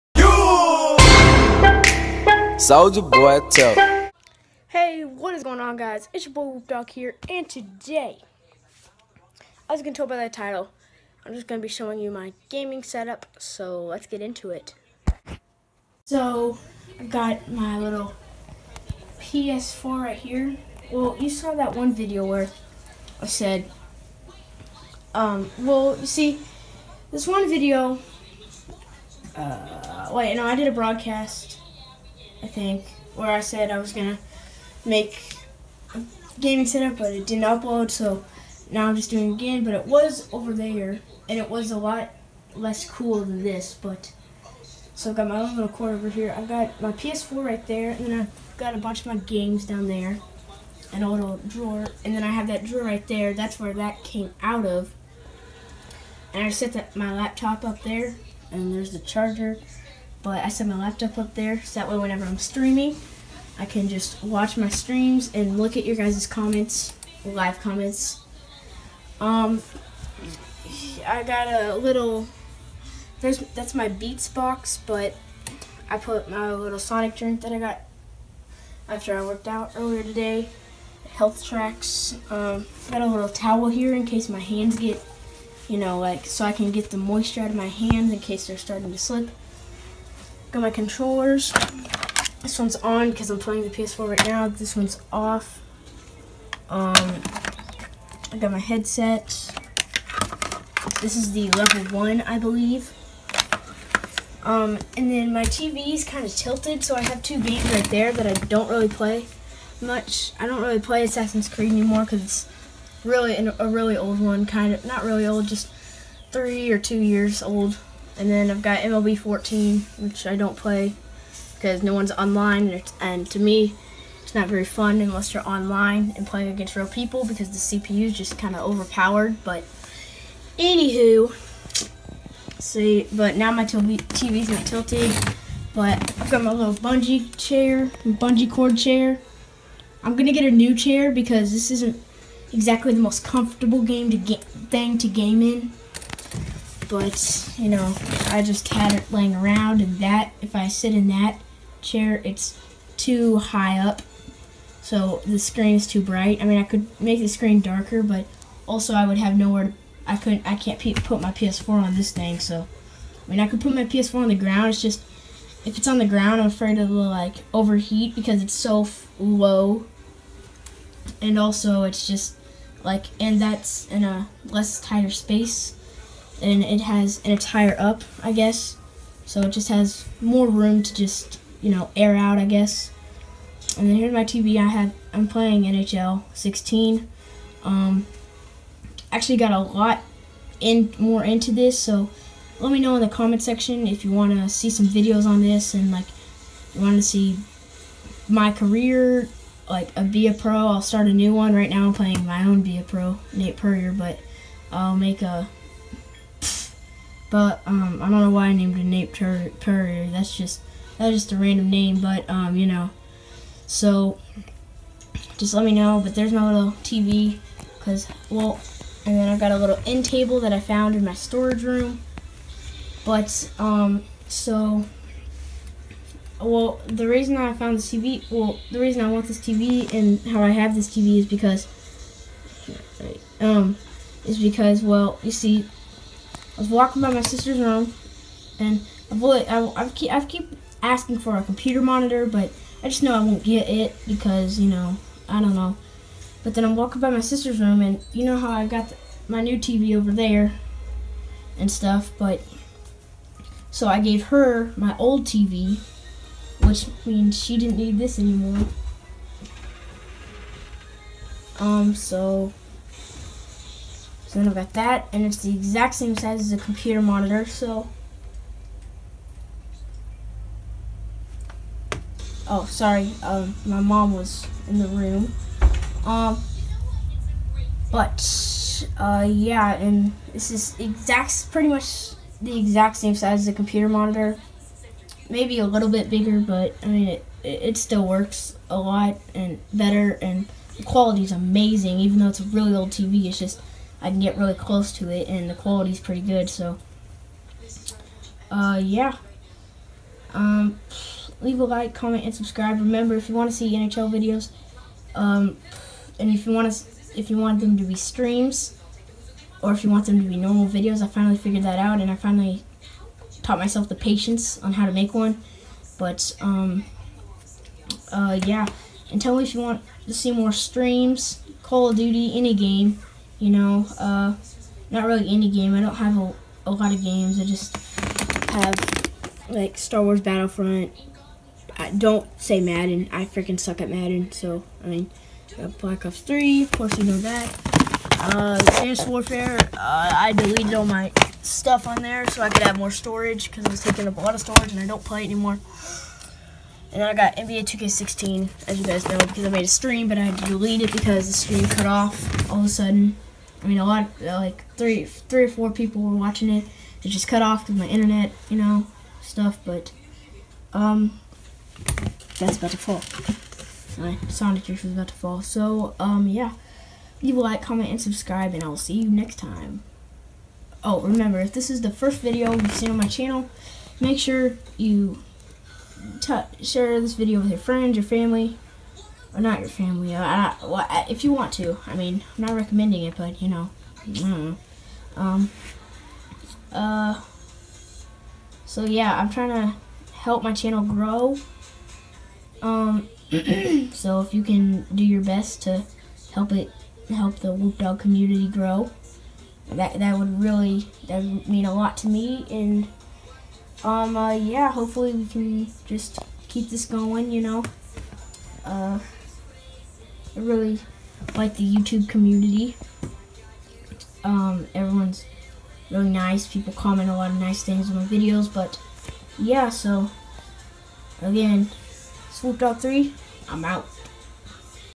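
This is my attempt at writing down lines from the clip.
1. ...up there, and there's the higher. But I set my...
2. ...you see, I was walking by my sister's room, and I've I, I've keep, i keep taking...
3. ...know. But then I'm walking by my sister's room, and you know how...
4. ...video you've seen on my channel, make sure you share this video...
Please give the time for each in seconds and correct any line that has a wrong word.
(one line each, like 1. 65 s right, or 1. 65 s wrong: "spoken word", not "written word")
1. 57 s wrong: "charger", not "higher"
2. 235 s wrong: "asking", not "taking"
3. 245 s right
4. 372 s right.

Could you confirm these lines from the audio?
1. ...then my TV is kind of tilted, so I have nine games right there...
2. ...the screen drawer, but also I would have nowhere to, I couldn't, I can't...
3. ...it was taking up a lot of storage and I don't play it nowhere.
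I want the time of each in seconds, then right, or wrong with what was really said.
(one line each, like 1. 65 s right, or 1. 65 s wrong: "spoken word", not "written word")
1. 105 s wrong: "two", not "nine"
2. 157 s wrong: "darker", not "drawer"
3. 343 s wrong: "anymore", not "nowhere".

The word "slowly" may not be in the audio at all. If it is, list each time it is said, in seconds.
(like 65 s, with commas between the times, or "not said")
not said.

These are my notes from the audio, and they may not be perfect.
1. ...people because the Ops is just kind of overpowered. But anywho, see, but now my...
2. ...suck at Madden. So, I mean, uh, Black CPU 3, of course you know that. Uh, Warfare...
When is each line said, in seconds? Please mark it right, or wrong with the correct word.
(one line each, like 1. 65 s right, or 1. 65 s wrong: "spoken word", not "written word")
1. 126 s wrong: "CPU", not "Ops"
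2. 333 s wrong: "Ops", not "CPU".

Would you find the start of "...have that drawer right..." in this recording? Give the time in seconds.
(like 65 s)
52 s.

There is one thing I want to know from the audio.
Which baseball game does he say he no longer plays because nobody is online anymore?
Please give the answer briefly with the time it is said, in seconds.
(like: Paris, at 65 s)
MLB 14, at 118 s.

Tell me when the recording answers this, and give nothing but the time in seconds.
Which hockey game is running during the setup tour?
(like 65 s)
185 s.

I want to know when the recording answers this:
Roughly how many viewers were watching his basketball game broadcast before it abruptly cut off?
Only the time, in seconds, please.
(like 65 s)
355 s.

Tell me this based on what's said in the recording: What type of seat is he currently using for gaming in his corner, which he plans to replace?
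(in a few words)
bungee cord chair.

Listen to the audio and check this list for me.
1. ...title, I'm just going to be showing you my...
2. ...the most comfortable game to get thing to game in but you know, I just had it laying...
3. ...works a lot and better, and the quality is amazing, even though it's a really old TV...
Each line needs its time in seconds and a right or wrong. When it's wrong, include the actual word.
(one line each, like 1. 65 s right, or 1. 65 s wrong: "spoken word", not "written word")
1. 10 s right
2. 142 s right
3. 288 s right.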